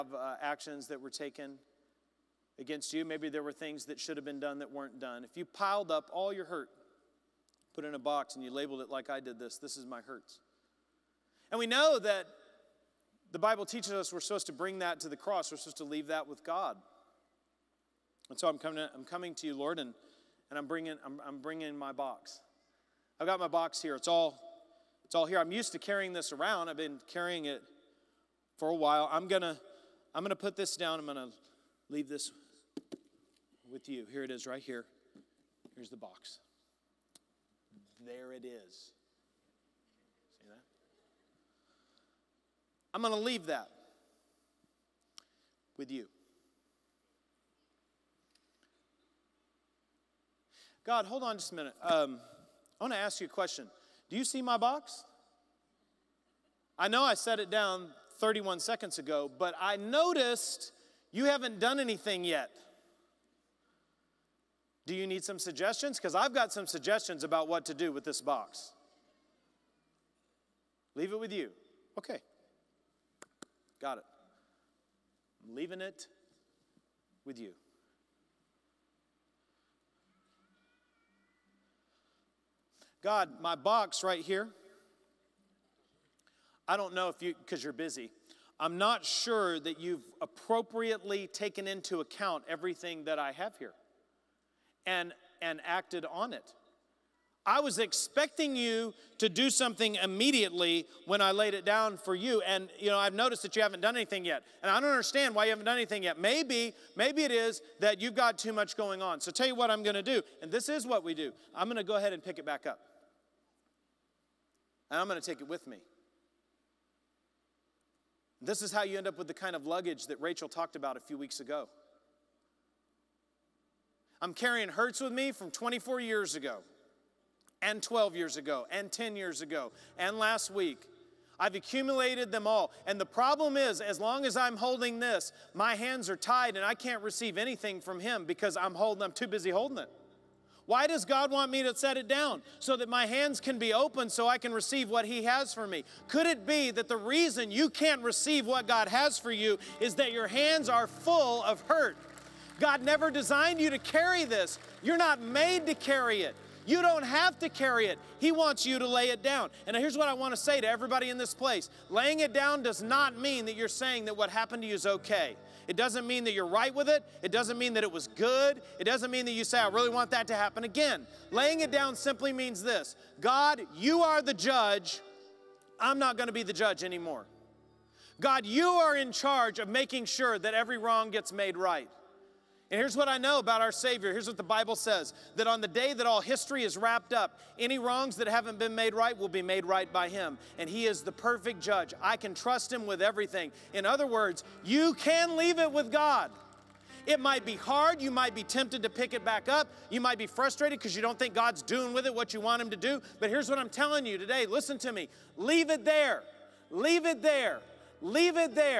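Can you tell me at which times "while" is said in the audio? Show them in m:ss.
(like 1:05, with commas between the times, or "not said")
0:28.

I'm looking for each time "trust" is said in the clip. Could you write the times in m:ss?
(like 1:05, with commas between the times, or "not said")
3:12.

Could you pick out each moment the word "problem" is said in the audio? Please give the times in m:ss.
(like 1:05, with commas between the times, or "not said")
2:13.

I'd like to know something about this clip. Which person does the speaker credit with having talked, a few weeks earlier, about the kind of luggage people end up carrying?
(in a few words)
Rachel.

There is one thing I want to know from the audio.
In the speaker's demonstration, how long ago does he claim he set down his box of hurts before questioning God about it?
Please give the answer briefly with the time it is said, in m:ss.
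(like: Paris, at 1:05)
31 seconds, at 0:58.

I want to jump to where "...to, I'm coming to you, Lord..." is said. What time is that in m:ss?
0:18.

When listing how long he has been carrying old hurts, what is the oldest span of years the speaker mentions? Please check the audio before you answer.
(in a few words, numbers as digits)
24 years.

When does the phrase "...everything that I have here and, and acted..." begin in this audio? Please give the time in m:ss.
1:32.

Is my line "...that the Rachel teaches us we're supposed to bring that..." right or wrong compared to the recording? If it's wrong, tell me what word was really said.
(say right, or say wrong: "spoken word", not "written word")
wrong: "Bible", not "Rachel".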